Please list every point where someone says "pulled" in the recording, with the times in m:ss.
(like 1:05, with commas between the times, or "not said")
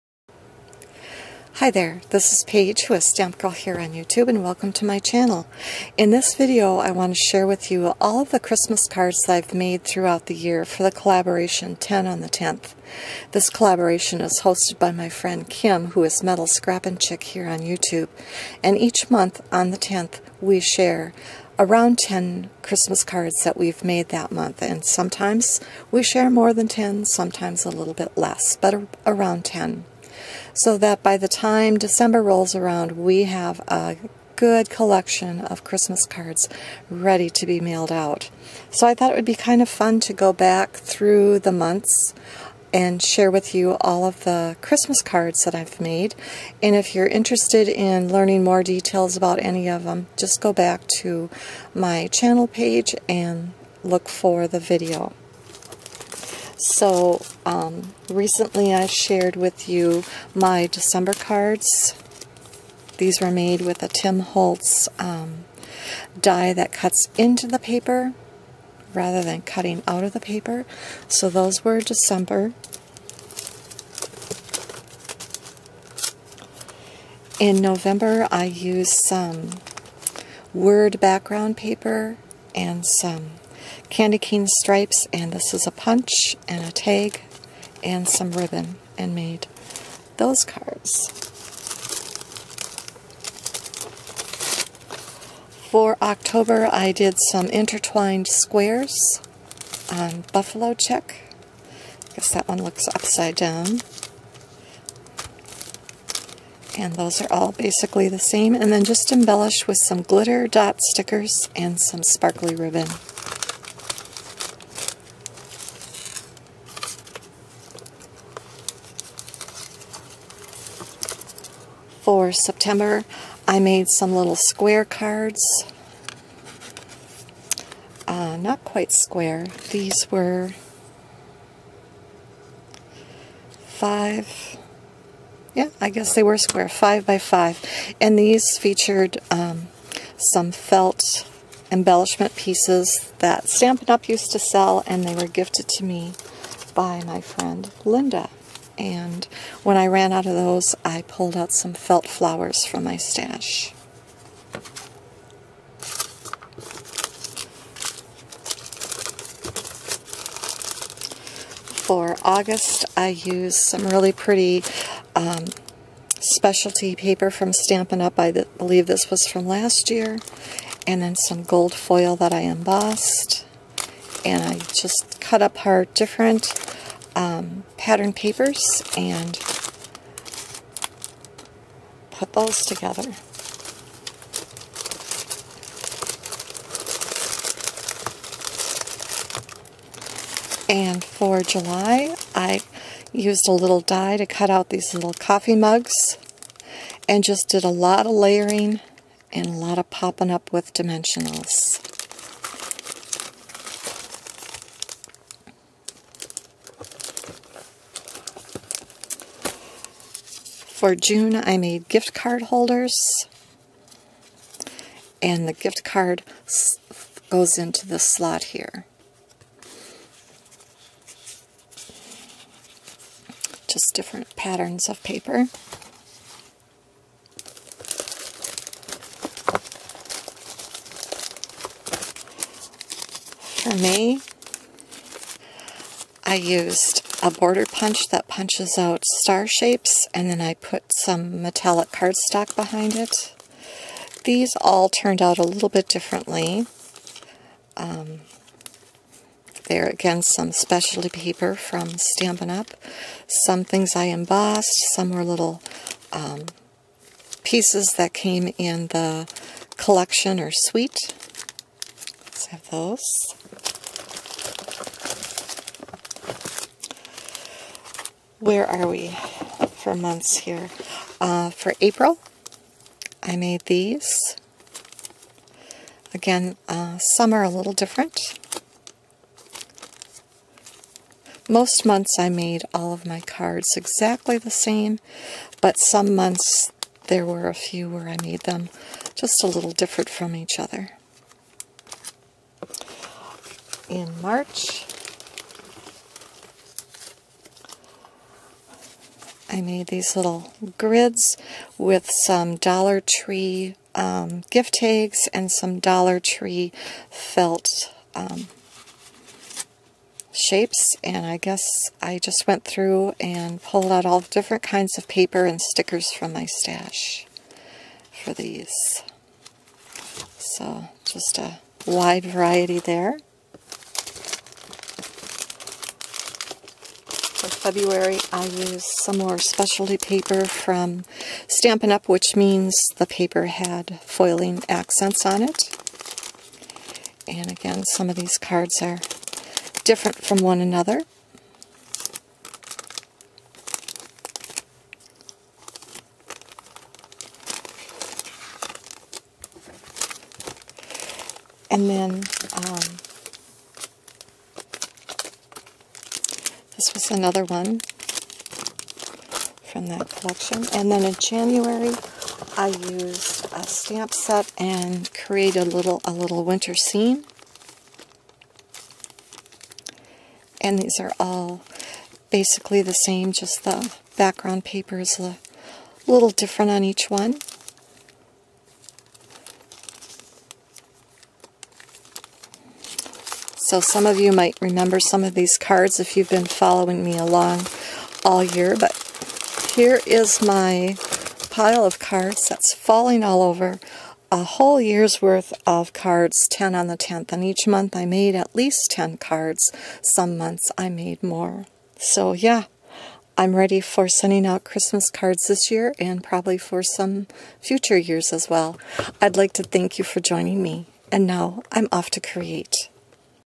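2:31, 5:13.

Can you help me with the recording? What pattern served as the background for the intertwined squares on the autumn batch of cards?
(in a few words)
Buffalo check.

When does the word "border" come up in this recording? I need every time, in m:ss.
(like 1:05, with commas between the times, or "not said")
3:57.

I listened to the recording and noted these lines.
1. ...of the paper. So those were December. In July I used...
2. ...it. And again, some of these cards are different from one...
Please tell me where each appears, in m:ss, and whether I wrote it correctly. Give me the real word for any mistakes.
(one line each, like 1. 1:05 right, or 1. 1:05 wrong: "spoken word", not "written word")
1. 1:10 wrong: "November", not "July"
2. 5:35 right.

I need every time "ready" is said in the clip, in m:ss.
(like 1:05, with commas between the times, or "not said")
0:36, 6:43.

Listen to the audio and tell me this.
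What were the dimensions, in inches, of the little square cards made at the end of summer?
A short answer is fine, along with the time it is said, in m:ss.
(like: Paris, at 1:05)
5 by 5, at 2:16.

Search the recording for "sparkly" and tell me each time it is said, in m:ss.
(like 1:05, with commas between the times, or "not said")
1:52.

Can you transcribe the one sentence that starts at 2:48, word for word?
I believe this was from last year.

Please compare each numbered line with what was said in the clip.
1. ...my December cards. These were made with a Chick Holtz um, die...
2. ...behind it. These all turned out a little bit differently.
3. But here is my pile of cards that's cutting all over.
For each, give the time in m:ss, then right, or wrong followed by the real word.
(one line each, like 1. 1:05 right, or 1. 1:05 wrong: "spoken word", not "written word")
1. 1:00 wrong: "Tim", not "Chick"
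2. 4:02 right
3. 6:28 wrong: "falling", not "cutting".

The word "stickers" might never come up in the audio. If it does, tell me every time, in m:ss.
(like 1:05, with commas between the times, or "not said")
1:50, 5:15.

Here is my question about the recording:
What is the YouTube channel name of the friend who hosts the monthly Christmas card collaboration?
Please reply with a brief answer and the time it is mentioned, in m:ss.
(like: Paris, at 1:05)
Metal Scrap and Chick, at 0:16.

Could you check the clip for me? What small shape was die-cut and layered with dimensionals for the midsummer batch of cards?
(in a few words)
Coffee mugs.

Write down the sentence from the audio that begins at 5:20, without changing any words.
So just a wide variety there.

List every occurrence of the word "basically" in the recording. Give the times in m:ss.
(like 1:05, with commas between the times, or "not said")
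1:47, 6:12.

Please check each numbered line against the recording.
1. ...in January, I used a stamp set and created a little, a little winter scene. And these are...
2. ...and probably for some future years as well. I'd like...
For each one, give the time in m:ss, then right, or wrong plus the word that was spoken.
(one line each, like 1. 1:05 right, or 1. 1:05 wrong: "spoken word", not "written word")
1. 6:01 right
2. 6:45 right.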